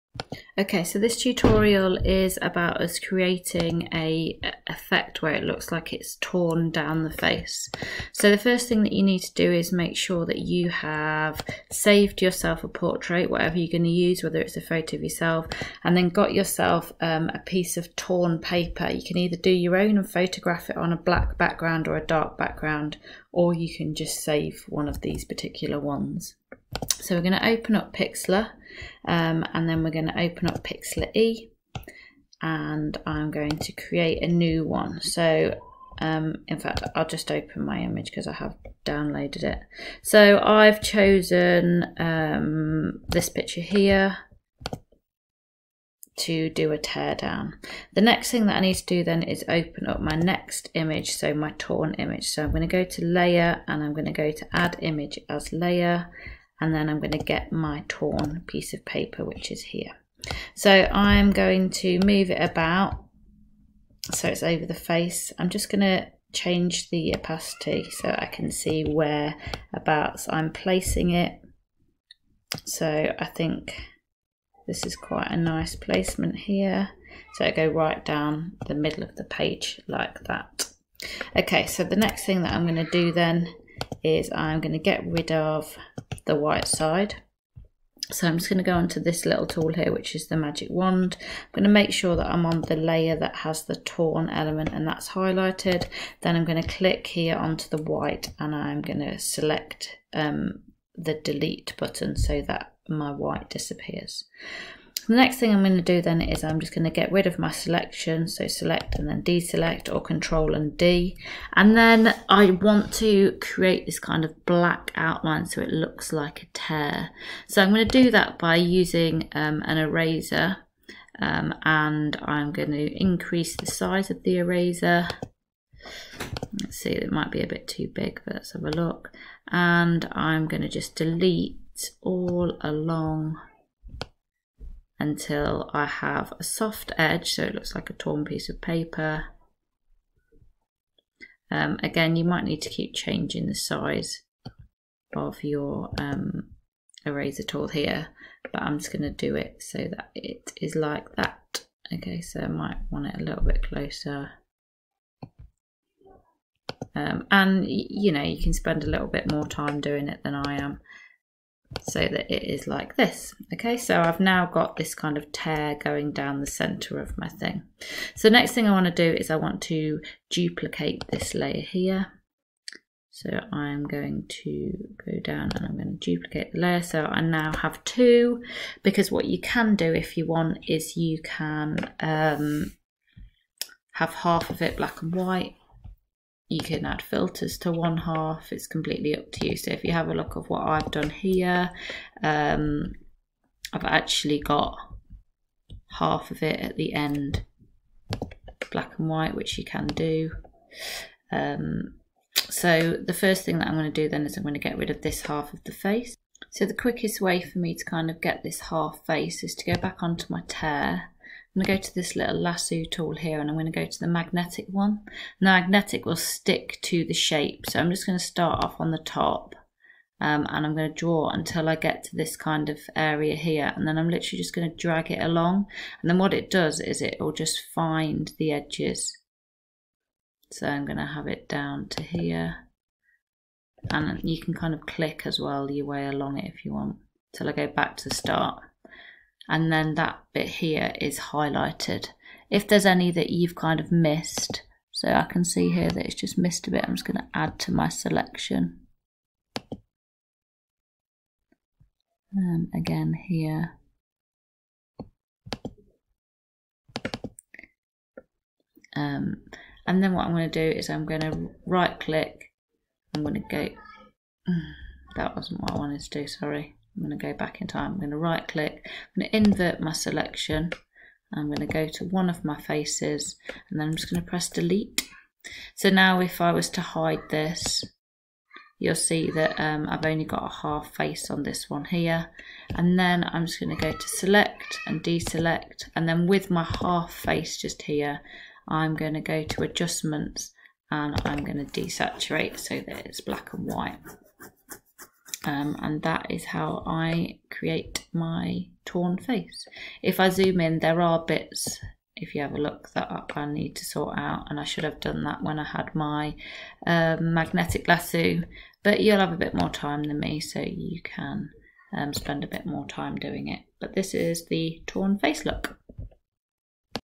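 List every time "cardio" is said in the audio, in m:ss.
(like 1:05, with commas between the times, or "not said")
not said.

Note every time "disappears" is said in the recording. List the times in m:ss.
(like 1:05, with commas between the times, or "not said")
1:43.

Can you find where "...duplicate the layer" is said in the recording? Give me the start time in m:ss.
2:56.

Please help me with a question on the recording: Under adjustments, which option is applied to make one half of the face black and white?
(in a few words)
Desaturate.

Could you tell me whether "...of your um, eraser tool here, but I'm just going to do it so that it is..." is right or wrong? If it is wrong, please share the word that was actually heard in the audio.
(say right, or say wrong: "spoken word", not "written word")
right.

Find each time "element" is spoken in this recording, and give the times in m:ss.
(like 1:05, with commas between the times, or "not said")
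1:34.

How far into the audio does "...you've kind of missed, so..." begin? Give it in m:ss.
4:03.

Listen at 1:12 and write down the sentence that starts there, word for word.
So I think this is quite a nice placement here.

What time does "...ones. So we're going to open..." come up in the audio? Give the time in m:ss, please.
0:25.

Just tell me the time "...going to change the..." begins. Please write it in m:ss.
1:05.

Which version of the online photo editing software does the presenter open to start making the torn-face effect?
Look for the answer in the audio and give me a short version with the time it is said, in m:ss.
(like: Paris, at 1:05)
Pixlr E, at 0:30.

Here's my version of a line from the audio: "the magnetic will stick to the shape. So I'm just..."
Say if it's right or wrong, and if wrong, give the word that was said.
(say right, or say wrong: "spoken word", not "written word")
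right.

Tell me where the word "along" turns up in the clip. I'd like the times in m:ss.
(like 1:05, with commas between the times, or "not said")
2:12, 3:45, 3:56.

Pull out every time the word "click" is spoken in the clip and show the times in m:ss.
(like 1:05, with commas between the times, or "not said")
1:36, 3:54, 4:21, 4:28.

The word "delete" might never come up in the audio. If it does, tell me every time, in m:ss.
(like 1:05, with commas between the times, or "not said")
1:41, 2:10, 4:34.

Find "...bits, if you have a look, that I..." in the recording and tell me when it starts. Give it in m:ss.
5:01.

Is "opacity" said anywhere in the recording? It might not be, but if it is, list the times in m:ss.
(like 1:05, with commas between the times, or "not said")
1:07.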